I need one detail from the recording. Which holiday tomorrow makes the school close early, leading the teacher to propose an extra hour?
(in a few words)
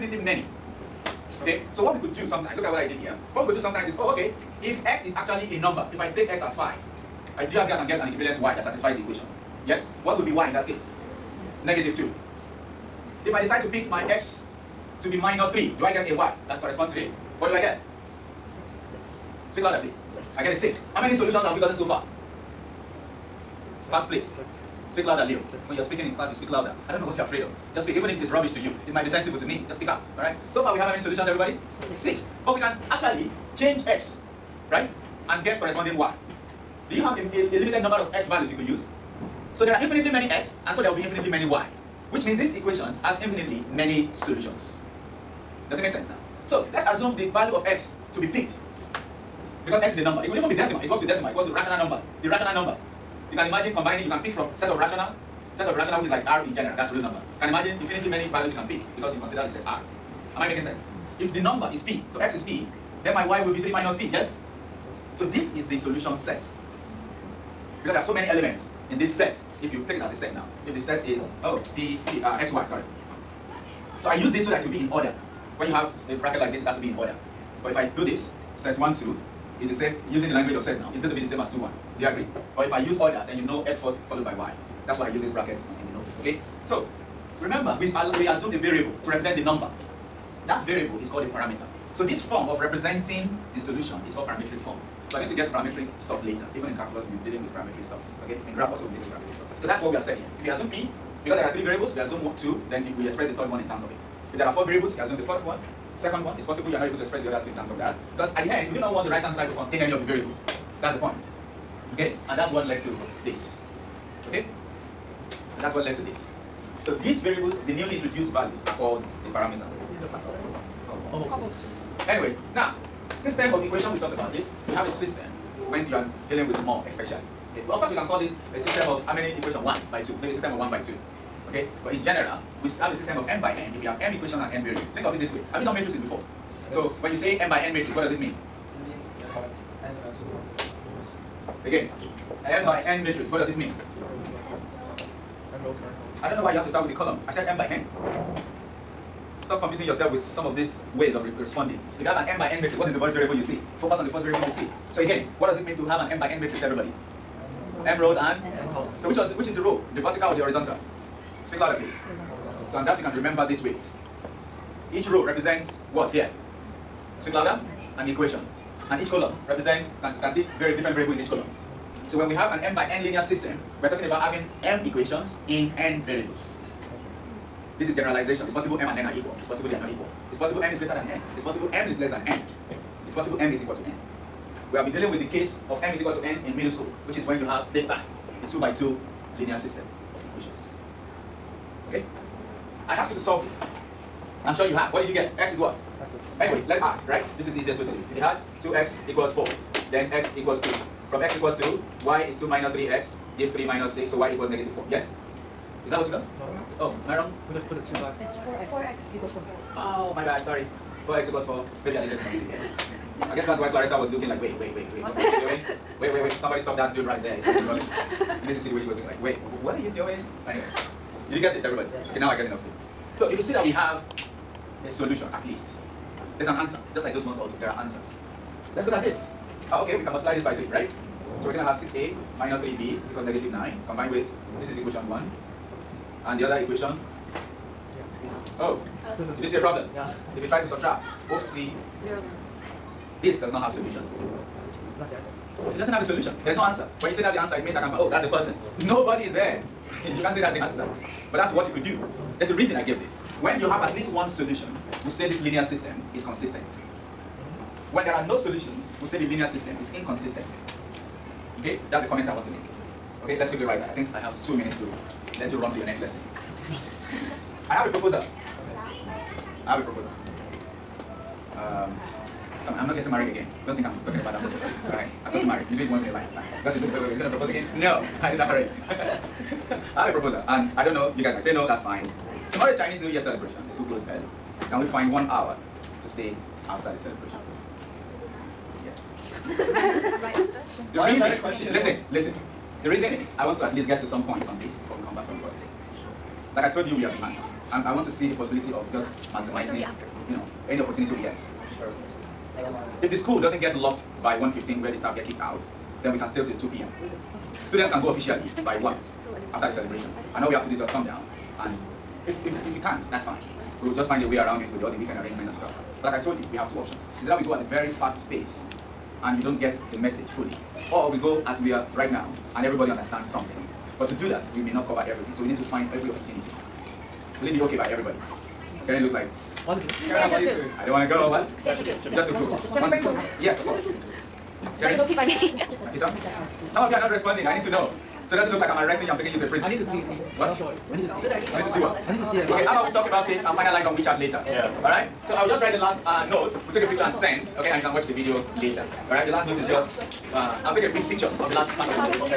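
Chinese New Year.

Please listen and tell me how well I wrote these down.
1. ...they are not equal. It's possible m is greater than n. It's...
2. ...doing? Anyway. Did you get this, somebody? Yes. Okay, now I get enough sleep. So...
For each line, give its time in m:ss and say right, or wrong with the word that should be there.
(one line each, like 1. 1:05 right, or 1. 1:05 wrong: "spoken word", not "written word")
1. 2:59 right
2. 3:39 wrong: "everybody", not "somebody".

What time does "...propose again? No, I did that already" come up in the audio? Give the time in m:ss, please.
4:37.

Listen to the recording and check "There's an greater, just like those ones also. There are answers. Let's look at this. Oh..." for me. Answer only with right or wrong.
wrong.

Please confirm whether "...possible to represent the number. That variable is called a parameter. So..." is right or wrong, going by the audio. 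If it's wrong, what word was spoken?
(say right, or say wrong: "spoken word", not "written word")
wrong: "variable", not "possible".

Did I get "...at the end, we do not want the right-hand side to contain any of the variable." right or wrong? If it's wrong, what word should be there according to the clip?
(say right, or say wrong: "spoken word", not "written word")
right.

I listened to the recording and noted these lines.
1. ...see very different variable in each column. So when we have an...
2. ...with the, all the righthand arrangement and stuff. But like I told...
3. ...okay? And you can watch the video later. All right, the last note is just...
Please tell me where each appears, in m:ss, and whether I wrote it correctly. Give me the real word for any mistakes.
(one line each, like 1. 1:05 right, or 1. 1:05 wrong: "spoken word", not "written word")
1. 2:50 right
2. 5:14 wrong: "weekend", not "righthand"
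3. 5:47 right.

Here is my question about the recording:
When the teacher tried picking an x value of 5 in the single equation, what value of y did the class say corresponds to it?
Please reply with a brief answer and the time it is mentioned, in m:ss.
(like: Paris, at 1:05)
-2, at 0:11.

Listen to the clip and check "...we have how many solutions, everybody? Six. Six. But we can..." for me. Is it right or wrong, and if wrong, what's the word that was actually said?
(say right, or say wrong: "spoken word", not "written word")
right.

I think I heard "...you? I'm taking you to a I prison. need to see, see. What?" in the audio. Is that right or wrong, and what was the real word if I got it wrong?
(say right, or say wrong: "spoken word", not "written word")
right.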